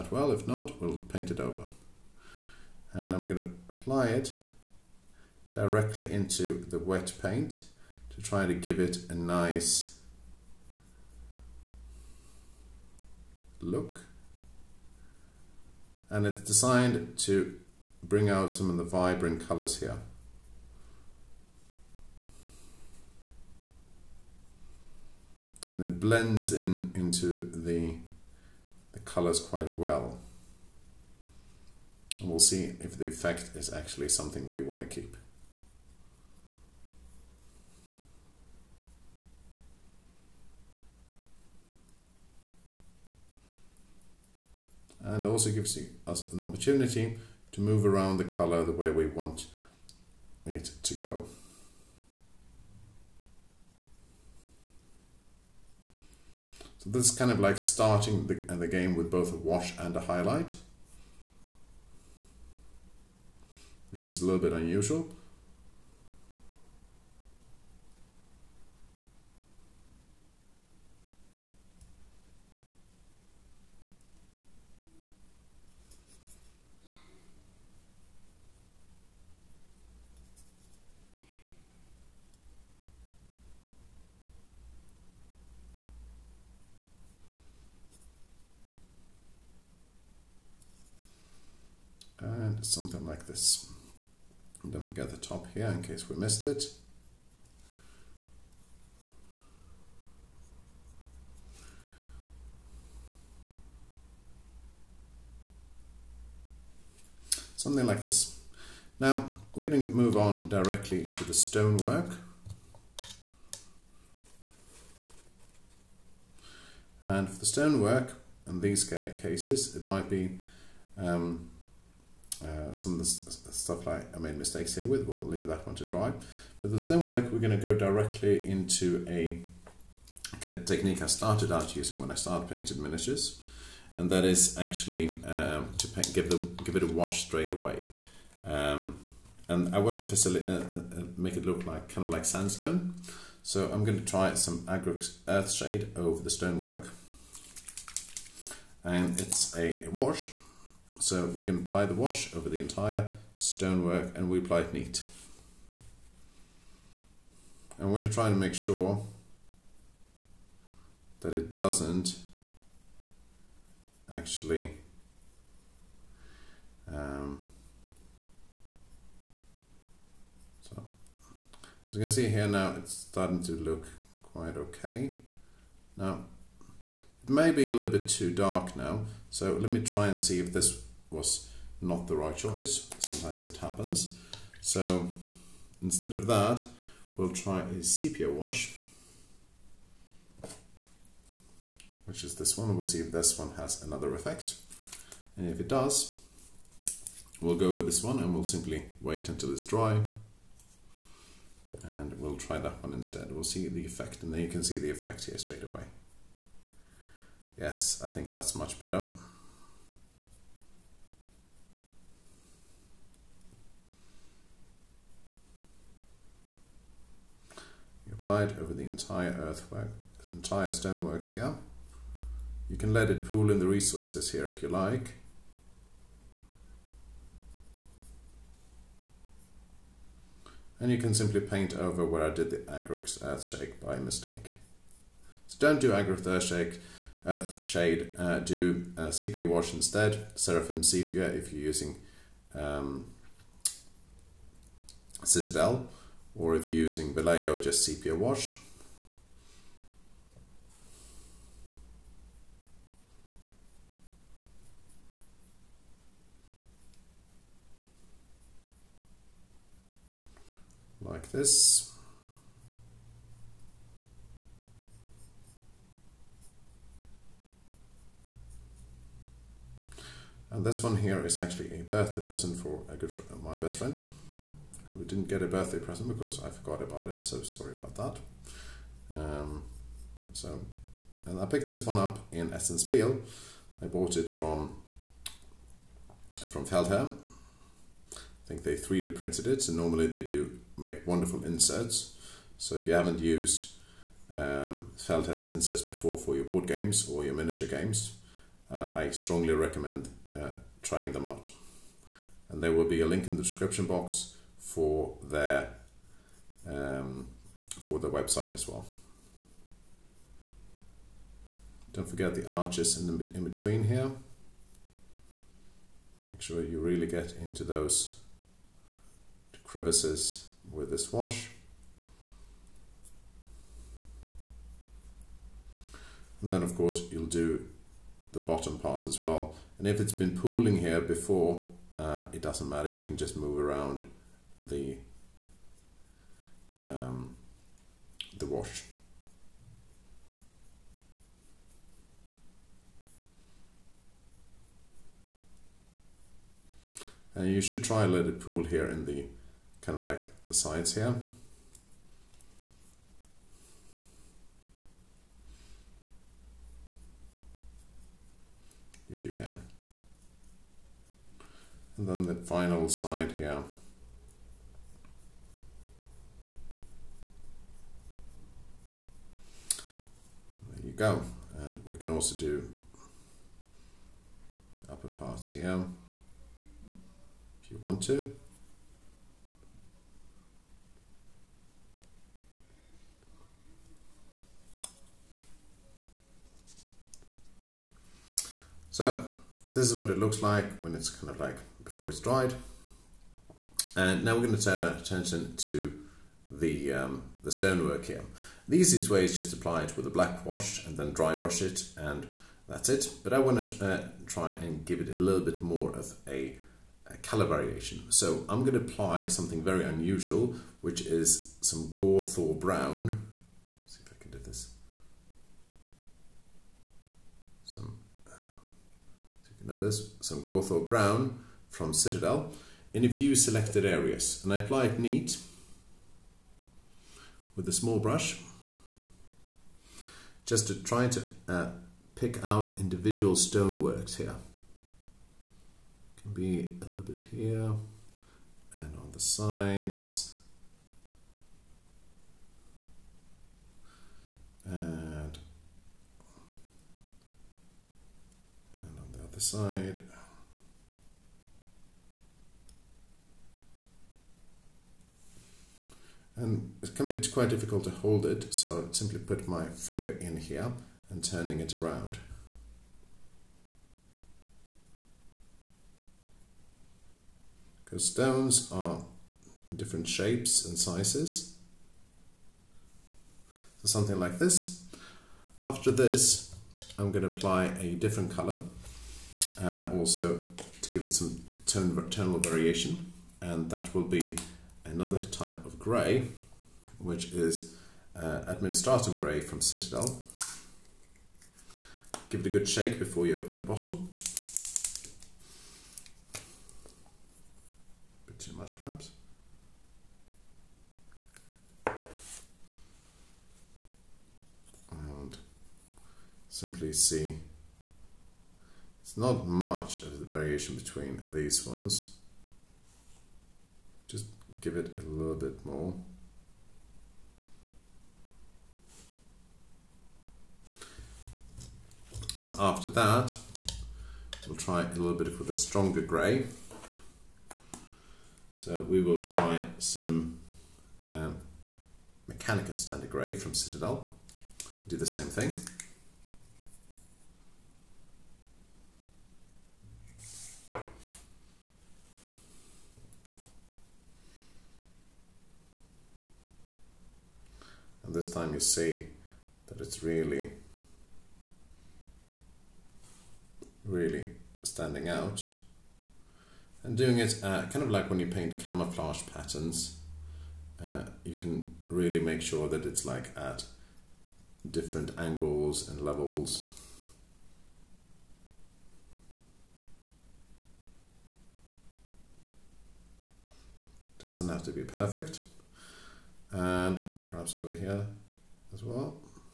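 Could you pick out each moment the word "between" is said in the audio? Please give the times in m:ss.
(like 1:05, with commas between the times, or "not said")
5:13, 8:30.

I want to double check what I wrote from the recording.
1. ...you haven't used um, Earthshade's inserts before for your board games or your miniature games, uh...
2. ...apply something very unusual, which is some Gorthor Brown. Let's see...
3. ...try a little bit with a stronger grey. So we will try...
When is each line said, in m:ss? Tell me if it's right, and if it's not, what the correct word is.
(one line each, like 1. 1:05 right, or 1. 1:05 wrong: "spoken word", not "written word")
1. 4:52 wrong: "Feldherr", not "Earthshade"
2. 6:48 right
3. 8:44 right.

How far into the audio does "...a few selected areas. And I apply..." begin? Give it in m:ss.
7:03.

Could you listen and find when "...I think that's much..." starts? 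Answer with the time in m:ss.
3:28.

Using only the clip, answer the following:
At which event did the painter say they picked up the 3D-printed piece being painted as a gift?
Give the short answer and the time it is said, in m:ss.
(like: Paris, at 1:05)
Spiel, at 4:42.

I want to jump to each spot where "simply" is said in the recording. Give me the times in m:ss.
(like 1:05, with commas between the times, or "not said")
3:18, 3:51, 7:38, 8:26.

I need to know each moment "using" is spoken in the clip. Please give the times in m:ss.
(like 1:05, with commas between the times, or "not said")
2:11, 4:01, 4:06.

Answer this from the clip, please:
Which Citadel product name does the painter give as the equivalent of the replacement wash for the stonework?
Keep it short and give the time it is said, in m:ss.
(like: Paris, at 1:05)
Seraphim Sepia, at 4:00.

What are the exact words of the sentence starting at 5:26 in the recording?
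And then of course you'll do the bottom part as well.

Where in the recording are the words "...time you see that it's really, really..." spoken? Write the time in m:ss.
9:08.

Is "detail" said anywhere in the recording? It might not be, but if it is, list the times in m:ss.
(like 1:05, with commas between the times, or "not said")
not said.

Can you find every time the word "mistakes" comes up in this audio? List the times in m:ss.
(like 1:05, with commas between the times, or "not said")
2:04, 3:53.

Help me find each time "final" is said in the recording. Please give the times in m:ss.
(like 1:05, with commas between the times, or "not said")
6:02.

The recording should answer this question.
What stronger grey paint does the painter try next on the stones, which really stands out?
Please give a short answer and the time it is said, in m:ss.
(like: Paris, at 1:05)
Mechanicus Standard Grey, at 8:52.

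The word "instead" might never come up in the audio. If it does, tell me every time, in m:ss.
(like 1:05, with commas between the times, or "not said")
3:05, 3:22, 3:59.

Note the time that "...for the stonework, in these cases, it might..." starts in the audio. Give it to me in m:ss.
1:57.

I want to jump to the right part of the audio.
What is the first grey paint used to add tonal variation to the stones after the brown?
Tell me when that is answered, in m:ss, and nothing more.
8:08.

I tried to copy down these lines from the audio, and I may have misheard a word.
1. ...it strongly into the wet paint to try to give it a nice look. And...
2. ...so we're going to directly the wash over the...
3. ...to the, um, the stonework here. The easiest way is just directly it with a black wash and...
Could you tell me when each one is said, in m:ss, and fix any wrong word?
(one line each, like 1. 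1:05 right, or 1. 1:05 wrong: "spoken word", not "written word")
1. 0:04 wrong: "directly", not "strongly"
2. 2:30 wrong: "apply", not "directly"
3. 6:35 wrong: "apply", not "directly".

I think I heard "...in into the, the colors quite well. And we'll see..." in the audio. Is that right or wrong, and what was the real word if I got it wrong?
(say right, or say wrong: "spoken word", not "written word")
right.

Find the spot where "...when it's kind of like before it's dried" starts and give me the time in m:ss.
6:30.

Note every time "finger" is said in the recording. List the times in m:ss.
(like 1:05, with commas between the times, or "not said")
7:39.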